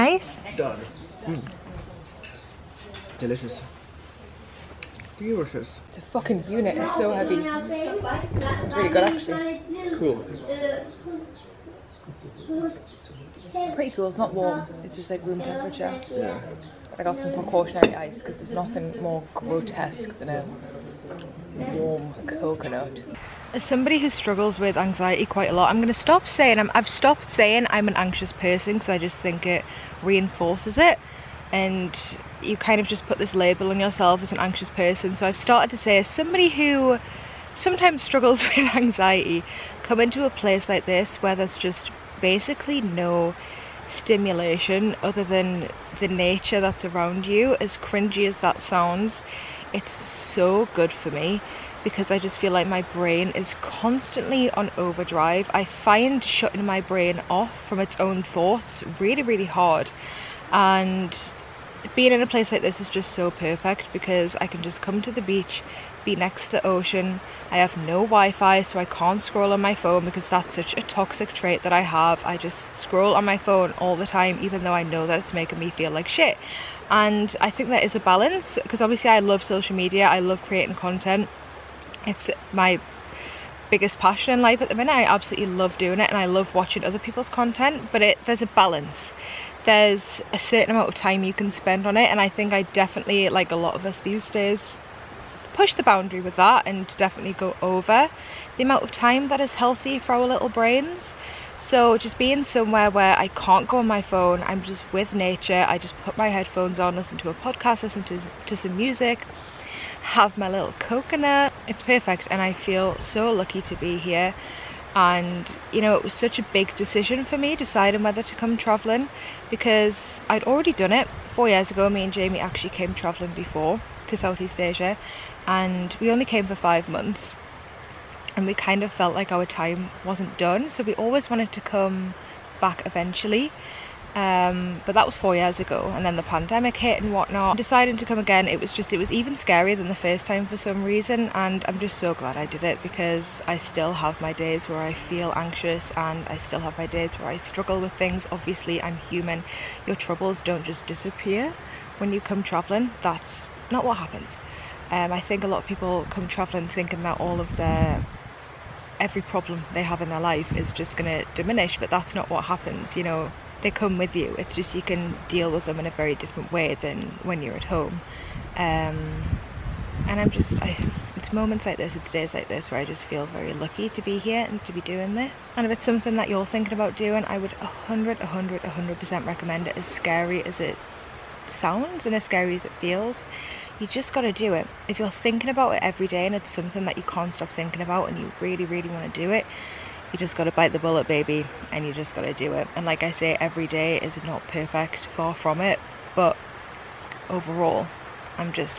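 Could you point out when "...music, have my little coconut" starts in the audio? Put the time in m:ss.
1:48.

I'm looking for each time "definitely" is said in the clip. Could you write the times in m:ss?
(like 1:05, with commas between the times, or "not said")
1:32, 1:36.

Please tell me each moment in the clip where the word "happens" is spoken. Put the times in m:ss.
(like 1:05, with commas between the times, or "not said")
2:33, 2:42.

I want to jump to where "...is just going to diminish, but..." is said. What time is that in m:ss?
2:40.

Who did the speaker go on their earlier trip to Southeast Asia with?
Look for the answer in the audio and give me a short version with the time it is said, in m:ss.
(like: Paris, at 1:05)
Jamie, at 2:02.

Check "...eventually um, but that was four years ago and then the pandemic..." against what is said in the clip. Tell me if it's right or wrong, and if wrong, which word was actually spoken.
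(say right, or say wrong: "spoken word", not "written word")
right.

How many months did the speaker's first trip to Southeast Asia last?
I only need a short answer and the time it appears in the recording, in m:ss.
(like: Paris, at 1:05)
5, at 2:06.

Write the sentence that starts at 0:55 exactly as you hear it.
I find shutting my brain off from its own thoughts really, really hard.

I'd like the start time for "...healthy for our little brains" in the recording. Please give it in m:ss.
1:39.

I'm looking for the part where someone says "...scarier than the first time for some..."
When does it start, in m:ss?
2:19.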